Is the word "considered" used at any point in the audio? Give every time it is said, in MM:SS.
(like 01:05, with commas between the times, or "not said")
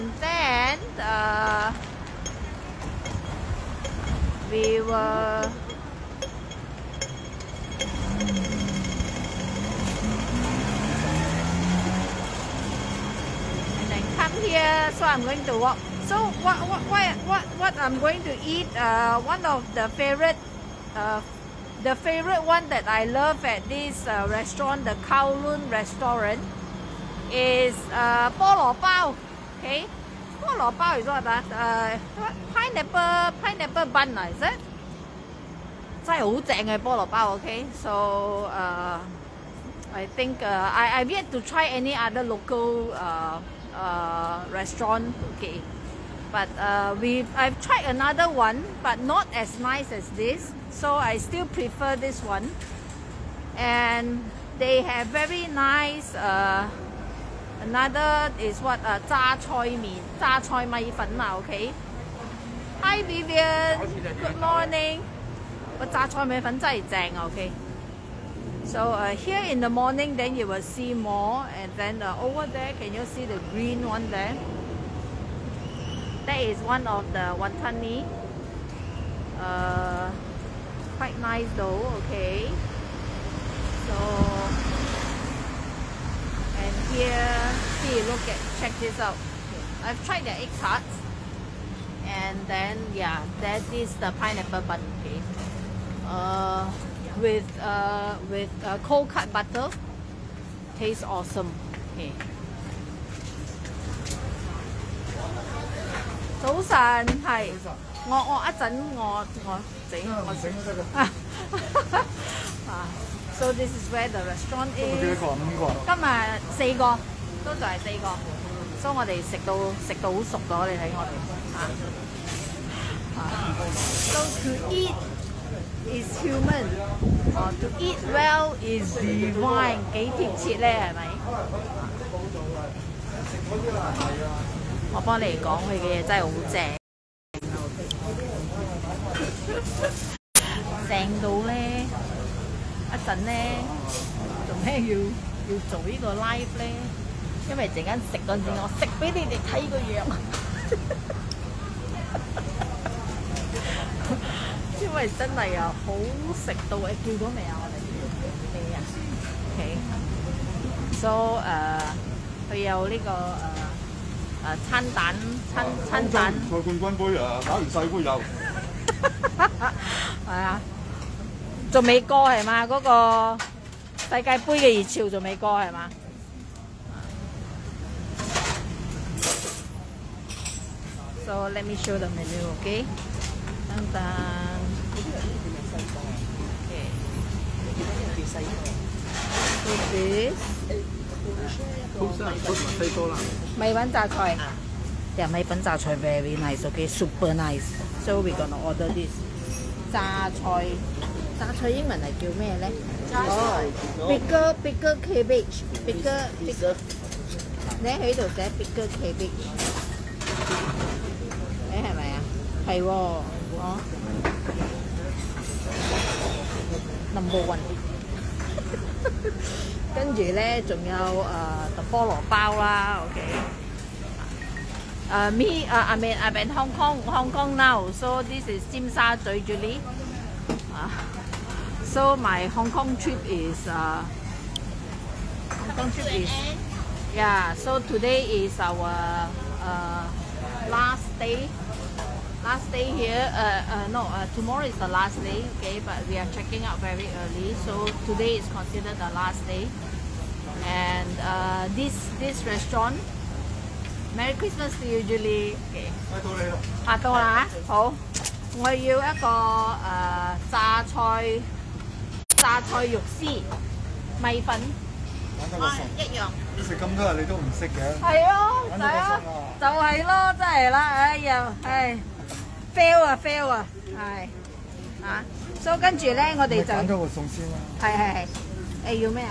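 04:08.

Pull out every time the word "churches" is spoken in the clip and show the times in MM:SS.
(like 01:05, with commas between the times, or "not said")
not said.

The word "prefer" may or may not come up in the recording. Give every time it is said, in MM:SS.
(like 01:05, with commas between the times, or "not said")
00:51.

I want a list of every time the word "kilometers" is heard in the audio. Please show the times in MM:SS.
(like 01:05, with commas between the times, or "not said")
not said.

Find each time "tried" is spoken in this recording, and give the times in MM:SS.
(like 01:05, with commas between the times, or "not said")
00:47, 01:30.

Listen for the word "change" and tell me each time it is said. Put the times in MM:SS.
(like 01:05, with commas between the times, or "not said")
not said.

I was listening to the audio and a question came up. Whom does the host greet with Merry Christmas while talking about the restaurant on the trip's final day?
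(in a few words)
Julie.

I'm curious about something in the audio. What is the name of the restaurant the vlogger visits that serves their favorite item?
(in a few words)
Kowloon restaurant.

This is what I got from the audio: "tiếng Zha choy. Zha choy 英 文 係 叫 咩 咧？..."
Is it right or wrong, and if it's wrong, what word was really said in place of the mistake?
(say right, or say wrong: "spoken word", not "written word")
right.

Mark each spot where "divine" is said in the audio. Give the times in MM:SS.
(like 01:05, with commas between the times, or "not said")
02:08.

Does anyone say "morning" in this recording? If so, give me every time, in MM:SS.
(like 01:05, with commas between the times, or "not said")
01:04, 01:09.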